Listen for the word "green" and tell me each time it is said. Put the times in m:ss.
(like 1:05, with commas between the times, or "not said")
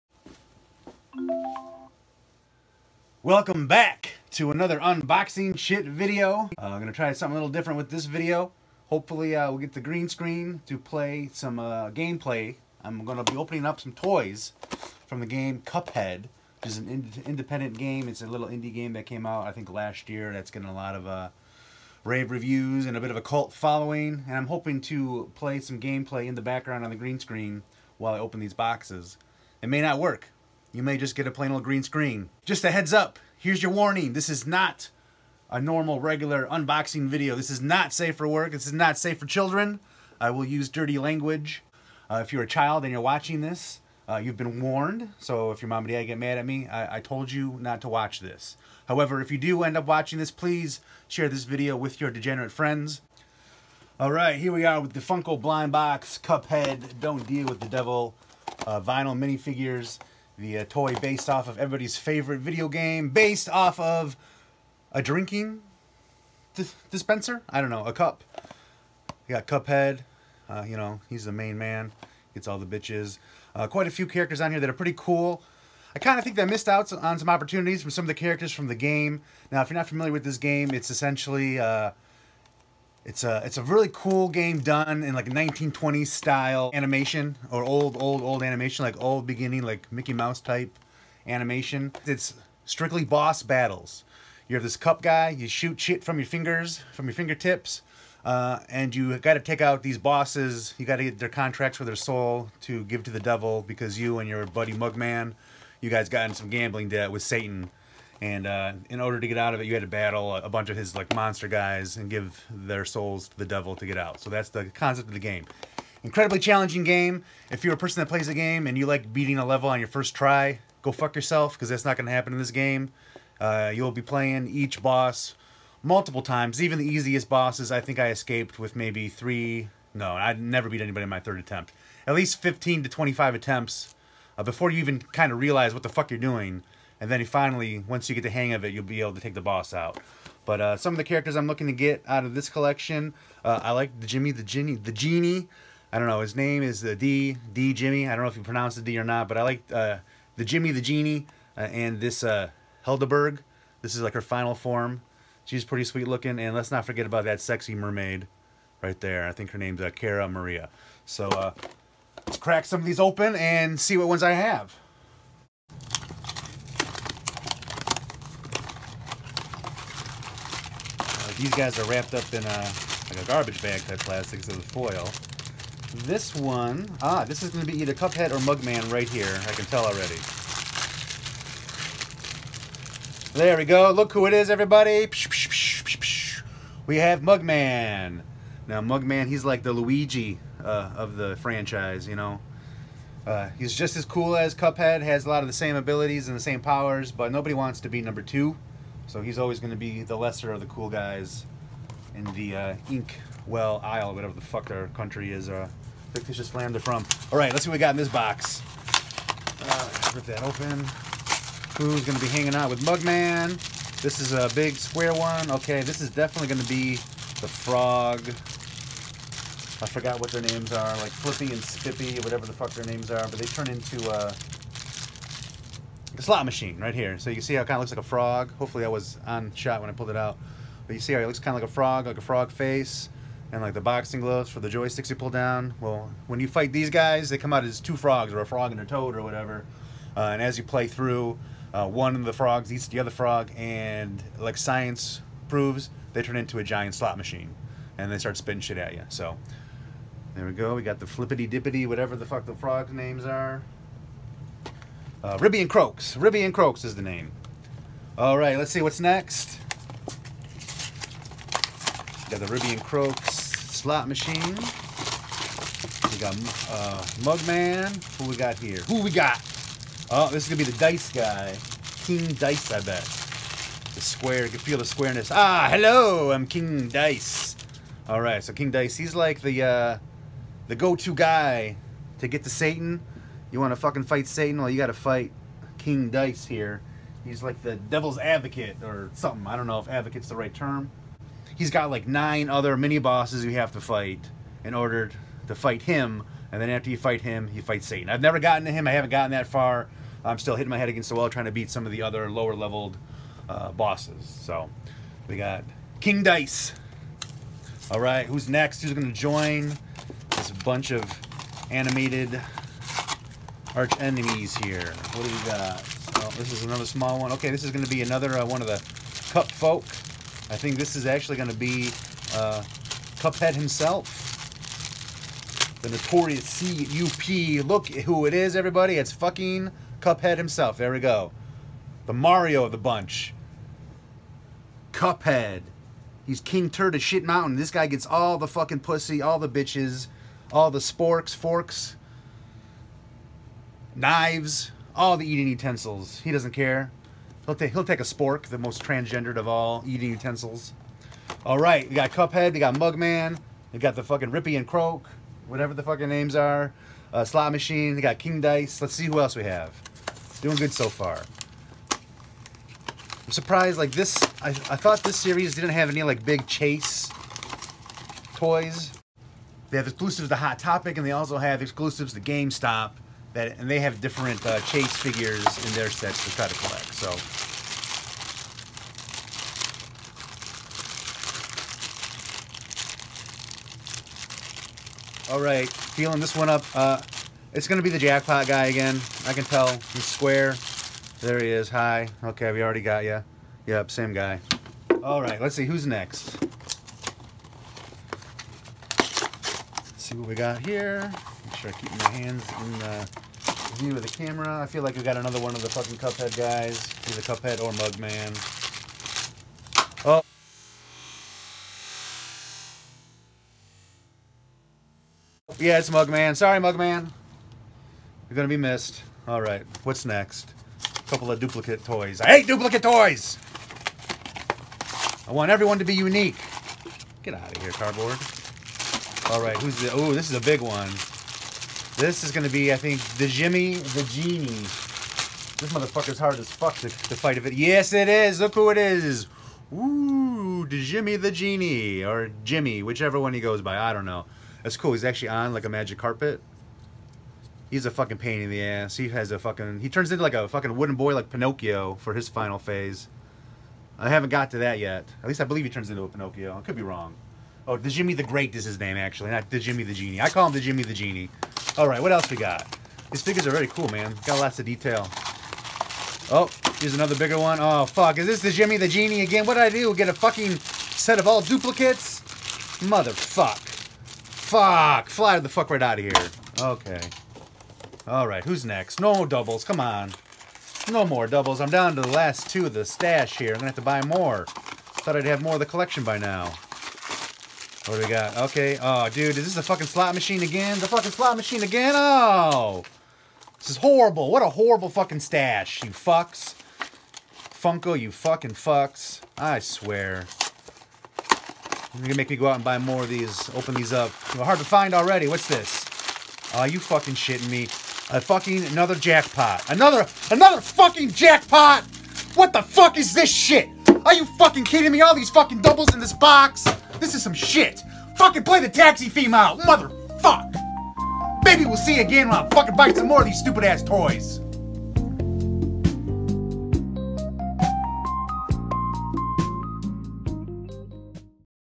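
0:09, 0:26, 0:31.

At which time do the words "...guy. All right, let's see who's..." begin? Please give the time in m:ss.
6:34.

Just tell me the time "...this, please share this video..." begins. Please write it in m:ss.
0:50.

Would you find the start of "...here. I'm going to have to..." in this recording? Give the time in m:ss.
8:03.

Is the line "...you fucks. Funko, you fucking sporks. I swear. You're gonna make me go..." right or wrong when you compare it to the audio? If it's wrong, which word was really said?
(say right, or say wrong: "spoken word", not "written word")
wrong: "fucks", not "sporks".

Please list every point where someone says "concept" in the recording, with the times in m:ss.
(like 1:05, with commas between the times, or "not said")
1:54.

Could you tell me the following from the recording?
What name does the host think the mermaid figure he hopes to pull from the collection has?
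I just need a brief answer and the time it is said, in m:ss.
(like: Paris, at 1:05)
Cara Maria, at 2:39.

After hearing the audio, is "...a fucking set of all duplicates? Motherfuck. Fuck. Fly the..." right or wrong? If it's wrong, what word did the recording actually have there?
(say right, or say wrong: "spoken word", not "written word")
right.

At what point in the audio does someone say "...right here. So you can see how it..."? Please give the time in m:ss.
3:46.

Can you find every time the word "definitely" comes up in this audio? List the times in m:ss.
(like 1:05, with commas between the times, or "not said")
3:36.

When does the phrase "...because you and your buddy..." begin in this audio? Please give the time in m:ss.
1:43.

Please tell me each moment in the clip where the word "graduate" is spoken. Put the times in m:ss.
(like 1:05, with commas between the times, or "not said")
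not said.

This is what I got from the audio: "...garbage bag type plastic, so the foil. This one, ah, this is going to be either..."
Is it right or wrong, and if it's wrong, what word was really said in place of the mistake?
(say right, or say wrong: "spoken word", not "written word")
right.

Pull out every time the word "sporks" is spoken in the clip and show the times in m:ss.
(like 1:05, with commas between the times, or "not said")
5:40, 5:48.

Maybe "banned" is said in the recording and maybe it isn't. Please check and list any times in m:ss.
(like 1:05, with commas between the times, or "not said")
not said.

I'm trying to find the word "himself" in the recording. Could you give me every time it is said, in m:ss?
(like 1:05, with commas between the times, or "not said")
5:23, 5:30.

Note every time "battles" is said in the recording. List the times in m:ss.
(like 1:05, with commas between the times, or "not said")
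1:33, 1:49.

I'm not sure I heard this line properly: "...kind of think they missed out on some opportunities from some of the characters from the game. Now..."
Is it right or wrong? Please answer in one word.
right.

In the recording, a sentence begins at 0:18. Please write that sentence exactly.
It's a little indie game that came out, I think, last year.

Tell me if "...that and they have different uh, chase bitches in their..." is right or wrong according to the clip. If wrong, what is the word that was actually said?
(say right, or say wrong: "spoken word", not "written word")
wrong: "figures", not "bitches".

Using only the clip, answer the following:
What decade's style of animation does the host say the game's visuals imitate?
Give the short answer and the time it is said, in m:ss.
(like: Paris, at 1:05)
1920s, at 1:25.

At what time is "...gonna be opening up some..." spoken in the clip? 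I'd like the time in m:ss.
0:13.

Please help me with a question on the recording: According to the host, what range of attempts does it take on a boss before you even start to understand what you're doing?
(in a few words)
15 to 25.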